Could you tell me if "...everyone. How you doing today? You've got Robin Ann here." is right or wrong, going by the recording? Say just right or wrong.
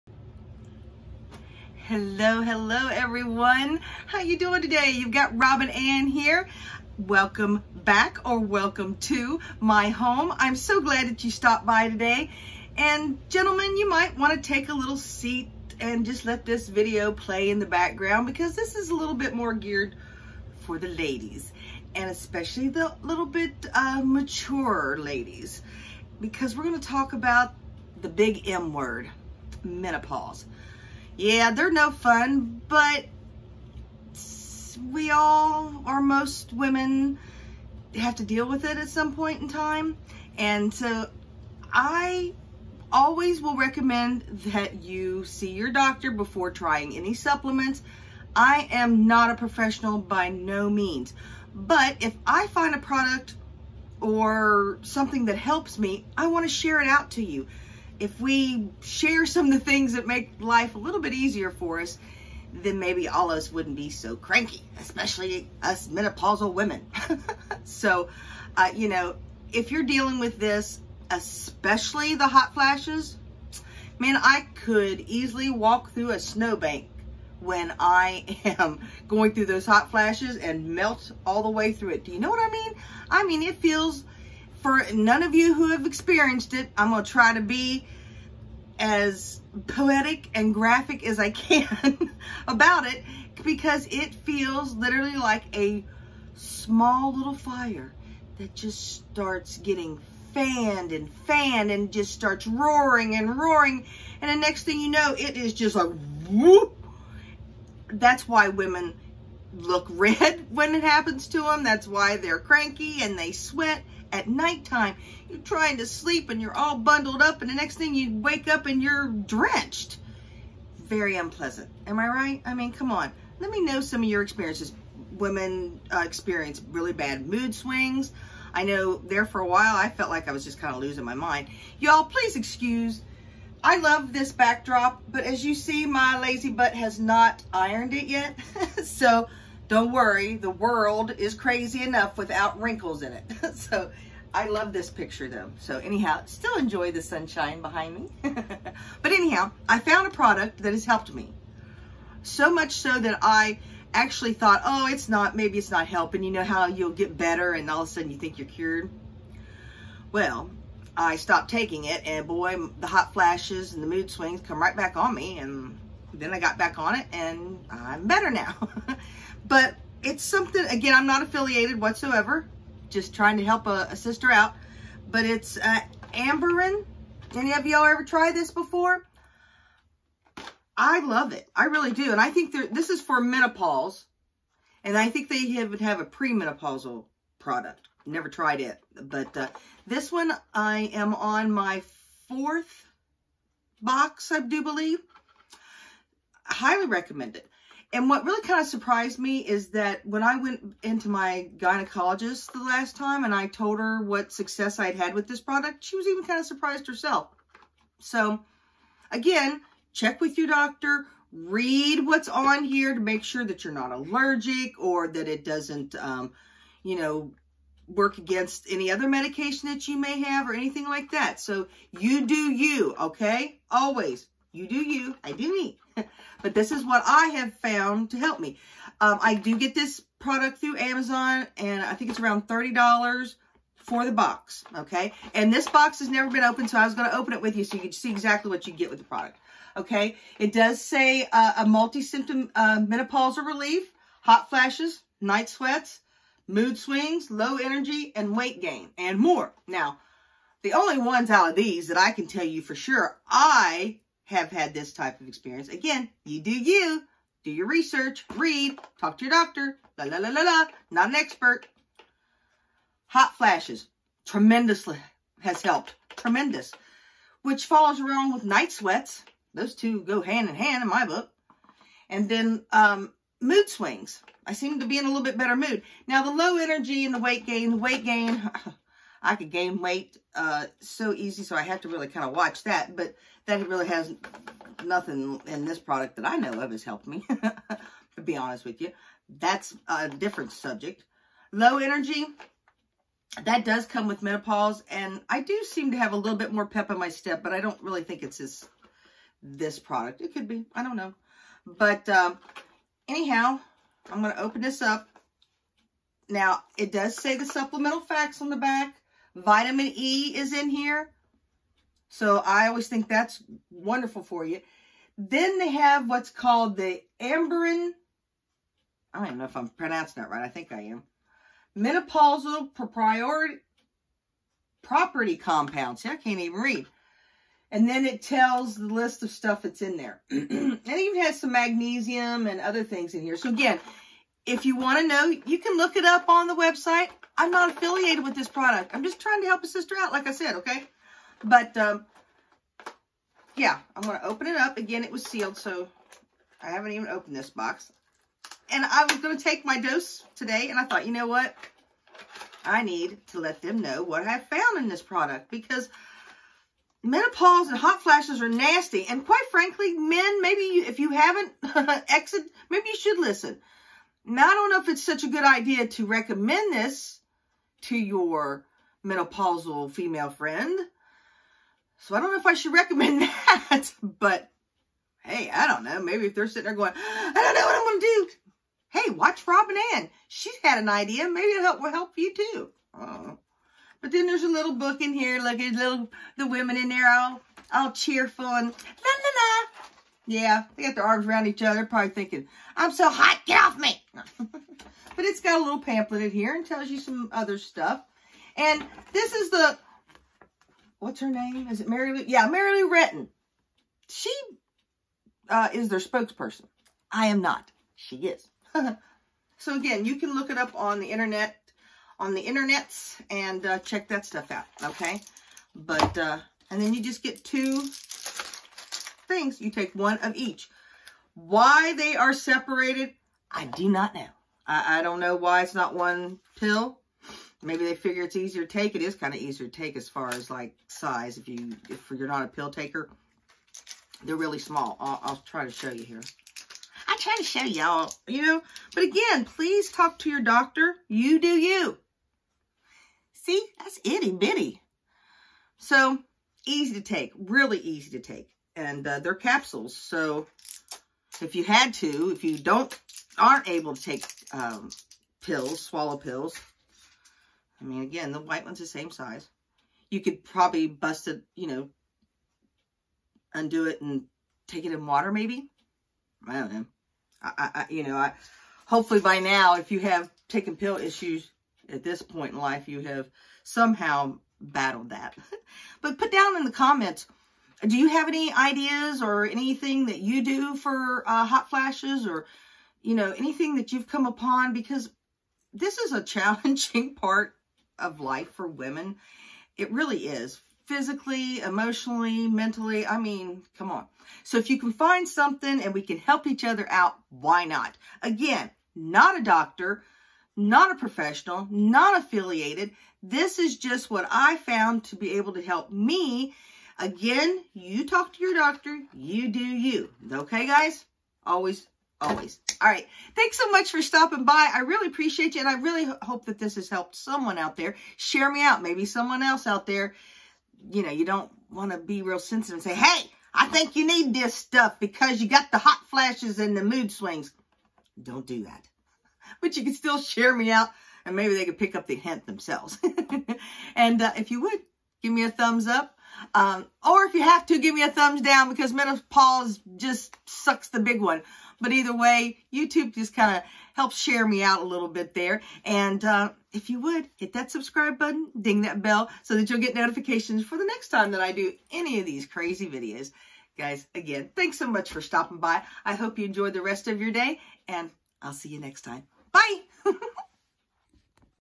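right.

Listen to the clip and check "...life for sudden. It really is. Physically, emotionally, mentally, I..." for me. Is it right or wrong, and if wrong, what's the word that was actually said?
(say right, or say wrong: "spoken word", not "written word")
wrong: "women", not "sudden".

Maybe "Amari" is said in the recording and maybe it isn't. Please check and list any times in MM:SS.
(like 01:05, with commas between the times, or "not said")
not said.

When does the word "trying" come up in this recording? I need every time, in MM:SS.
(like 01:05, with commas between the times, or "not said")
00:46, 01:55, 02:53, 05:39.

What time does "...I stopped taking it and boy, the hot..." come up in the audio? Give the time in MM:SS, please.
02:40.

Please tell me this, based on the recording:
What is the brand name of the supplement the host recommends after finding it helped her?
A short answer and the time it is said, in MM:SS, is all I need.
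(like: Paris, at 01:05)
Amberen, at 02:56.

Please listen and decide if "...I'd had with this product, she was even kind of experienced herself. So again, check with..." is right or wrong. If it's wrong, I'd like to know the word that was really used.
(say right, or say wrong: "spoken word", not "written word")
wrong: "surprised", not "experienced".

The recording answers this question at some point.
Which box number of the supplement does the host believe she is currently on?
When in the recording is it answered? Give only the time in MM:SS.
03:12.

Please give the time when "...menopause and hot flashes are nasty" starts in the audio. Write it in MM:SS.
05:57.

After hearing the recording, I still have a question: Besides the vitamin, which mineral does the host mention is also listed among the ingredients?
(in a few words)
magnesium.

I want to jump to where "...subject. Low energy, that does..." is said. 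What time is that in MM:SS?
04:50.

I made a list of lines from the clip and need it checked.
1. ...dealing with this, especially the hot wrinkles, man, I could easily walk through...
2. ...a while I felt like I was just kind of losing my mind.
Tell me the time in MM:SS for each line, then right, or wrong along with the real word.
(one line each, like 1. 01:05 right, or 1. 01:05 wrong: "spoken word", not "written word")
1. 01:09 wrong: "flashes", not "wrinkles"
2. 02:09 right.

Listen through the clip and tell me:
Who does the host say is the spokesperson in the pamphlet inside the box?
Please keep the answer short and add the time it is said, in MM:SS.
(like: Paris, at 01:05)
Mary Lou Retton, at 06:42.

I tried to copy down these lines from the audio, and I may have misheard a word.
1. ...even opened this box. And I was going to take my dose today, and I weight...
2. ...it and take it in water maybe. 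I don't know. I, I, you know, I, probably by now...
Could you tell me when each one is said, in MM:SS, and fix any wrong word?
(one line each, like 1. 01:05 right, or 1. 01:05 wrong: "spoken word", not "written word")
1. 05:46 wrong: "thought", not "weight"
2. 07:43 wrong: "hopefully", not "probably".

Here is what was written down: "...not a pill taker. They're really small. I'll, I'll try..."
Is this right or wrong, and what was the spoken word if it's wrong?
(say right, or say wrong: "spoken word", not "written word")
right.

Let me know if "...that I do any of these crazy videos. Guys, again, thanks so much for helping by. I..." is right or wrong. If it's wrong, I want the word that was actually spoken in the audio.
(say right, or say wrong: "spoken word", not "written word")
wrong: "stopping", not "helping".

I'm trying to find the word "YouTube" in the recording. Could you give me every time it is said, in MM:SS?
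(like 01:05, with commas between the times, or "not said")
09:02.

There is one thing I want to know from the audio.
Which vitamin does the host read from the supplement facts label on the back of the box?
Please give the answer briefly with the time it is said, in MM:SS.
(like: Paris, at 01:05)
Vitamin E, at 05:09.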